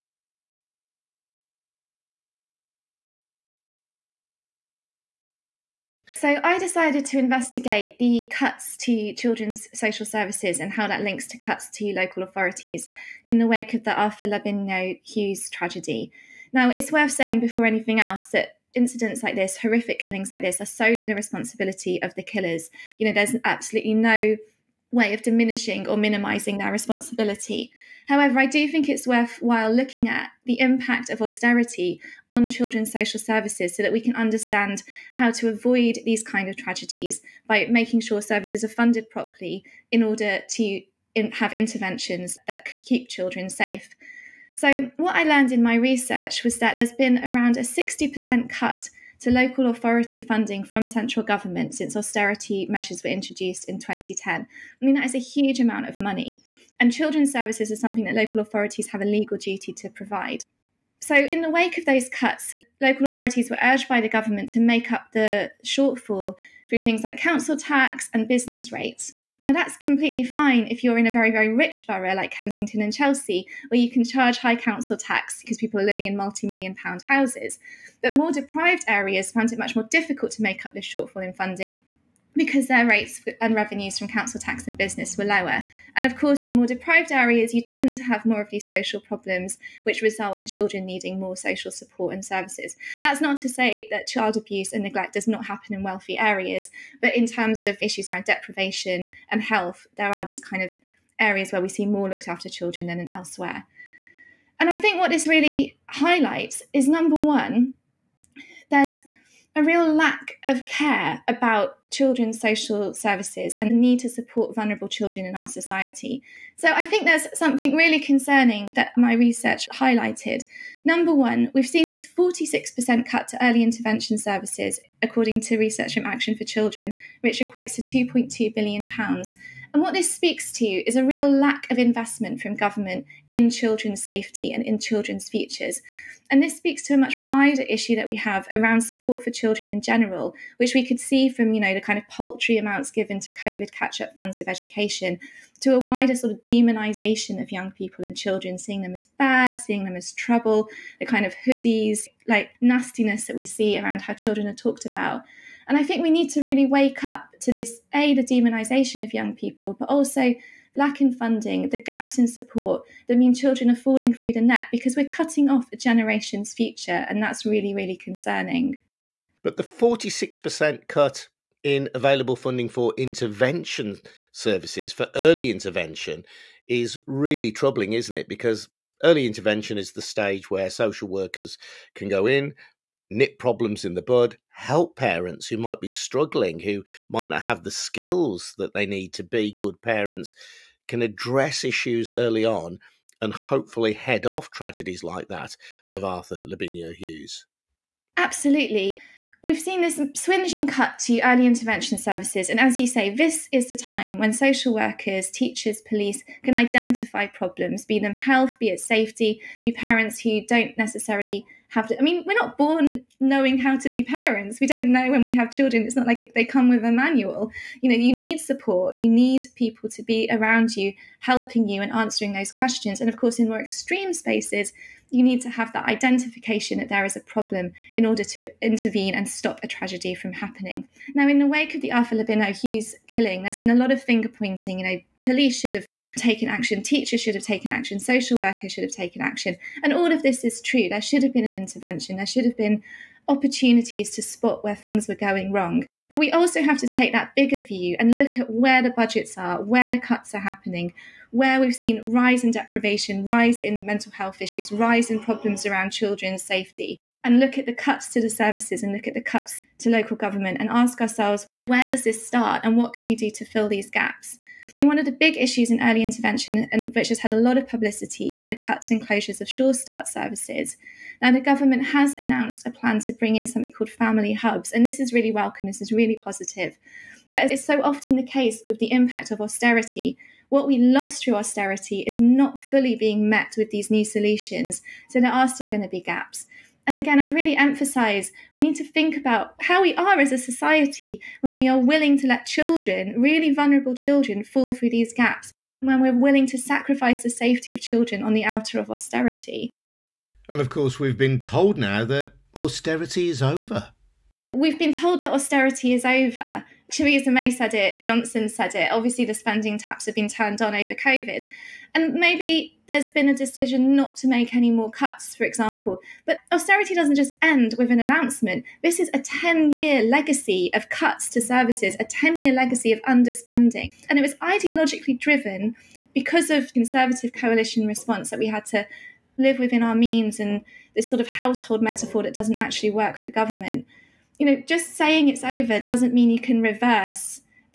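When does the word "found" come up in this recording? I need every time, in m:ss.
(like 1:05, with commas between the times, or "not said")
1:19.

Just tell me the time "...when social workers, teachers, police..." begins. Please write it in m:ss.
3:24.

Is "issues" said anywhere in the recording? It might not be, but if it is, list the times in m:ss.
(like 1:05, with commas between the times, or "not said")
1:37, 2:17, 3:11, 4:14, 4:25.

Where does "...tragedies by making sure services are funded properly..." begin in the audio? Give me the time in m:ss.
0:36.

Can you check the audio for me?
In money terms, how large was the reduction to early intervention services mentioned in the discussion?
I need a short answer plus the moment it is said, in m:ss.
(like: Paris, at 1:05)
£2.2 billion, at 2:07.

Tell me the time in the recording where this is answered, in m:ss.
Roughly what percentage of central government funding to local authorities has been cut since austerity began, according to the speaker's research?
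0:47.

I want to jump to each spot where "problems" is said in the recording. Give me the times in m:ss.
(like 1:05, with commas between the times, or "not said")
1:29, 3:03, 3:27, 3:47, 4:15.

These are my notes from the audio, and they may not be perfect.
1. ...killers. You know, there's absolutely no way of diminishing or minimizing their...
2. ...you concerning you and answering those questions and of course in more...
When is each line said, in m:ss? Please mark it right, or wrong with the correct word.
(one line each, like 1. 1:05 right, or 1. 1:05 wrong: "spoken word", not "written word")
1. 0:22 right
2. 3:40 wrong: "helping", not "concerning".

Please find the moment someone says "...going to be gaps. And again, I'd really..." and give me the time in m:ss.
4:45.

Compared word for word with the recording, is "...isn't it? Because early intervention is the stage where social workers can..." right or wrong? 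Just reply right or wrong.
right.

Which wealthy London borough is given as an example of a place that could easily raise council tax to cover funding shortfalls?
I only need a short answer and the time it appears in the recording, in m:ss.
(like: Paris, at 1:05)
Kensington and Chelsea, at 1:12.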